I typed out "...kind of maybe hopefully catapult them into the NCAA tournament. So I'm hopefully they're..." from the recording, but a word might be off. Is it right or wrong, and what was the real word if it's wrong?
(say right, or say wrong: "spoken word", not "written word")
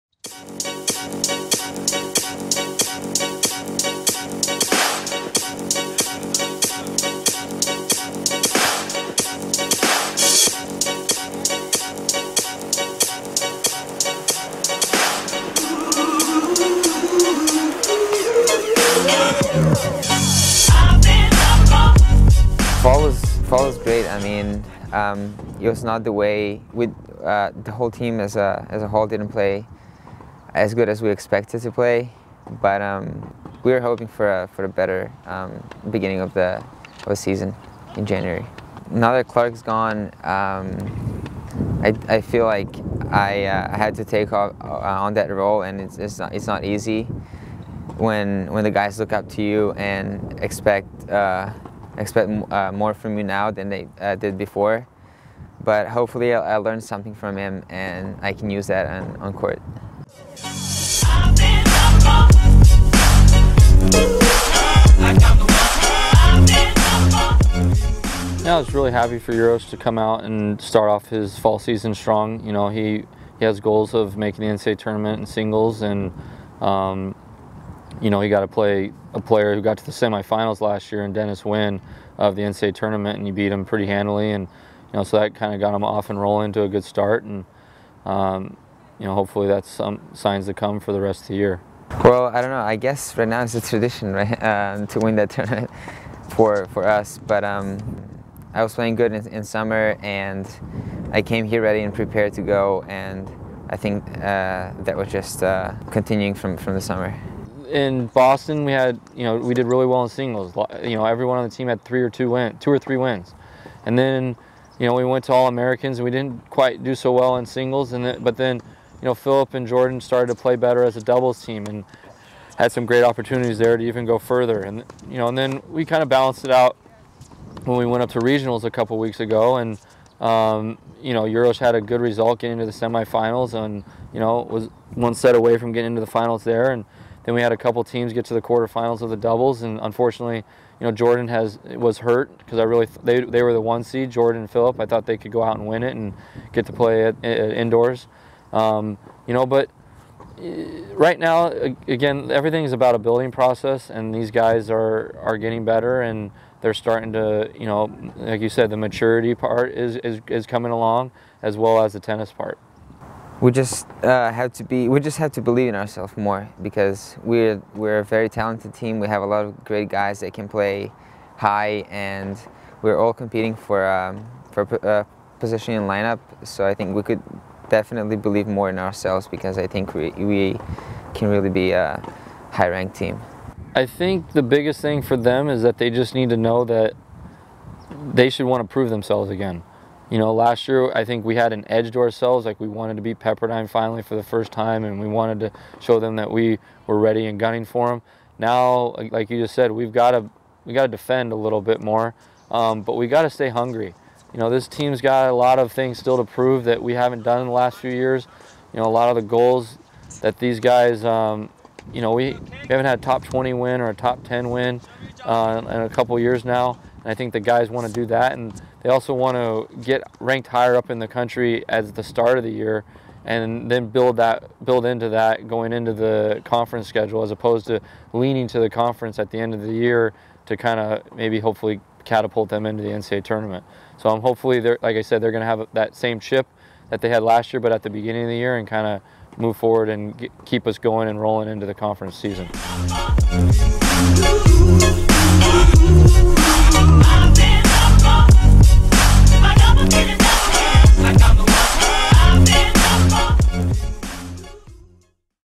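right.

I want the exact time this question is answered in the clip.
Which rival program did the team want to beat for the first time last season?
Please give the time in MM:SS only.
03:13.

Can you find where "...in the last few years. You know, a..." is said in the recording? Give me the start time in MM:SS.
03:27.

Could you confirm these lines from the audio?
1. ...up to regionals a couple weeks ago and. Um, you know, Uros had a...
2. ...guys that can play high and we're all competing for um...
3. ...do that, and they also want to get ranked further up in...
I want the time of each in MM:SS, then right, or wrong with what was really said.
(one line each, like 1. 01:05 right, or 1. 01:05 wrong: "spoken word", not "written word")
1. 02:08 right
2. 02:49 right
3. 03:37 wrong: "higher", not "further".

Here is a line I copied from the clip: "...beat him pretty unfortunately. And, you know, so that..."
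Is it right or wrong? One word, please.
wrong.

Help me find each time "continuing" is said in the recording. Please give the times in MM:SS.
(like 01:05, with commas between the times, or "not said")
01:45.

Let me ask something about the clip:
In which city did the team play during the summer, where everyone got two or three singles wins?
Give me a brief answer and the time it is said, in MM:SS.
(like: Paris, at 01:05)
Boston, at 01:48.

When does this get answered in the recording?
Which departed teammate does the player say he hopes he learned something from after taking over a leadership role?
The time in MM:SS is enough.
00:39.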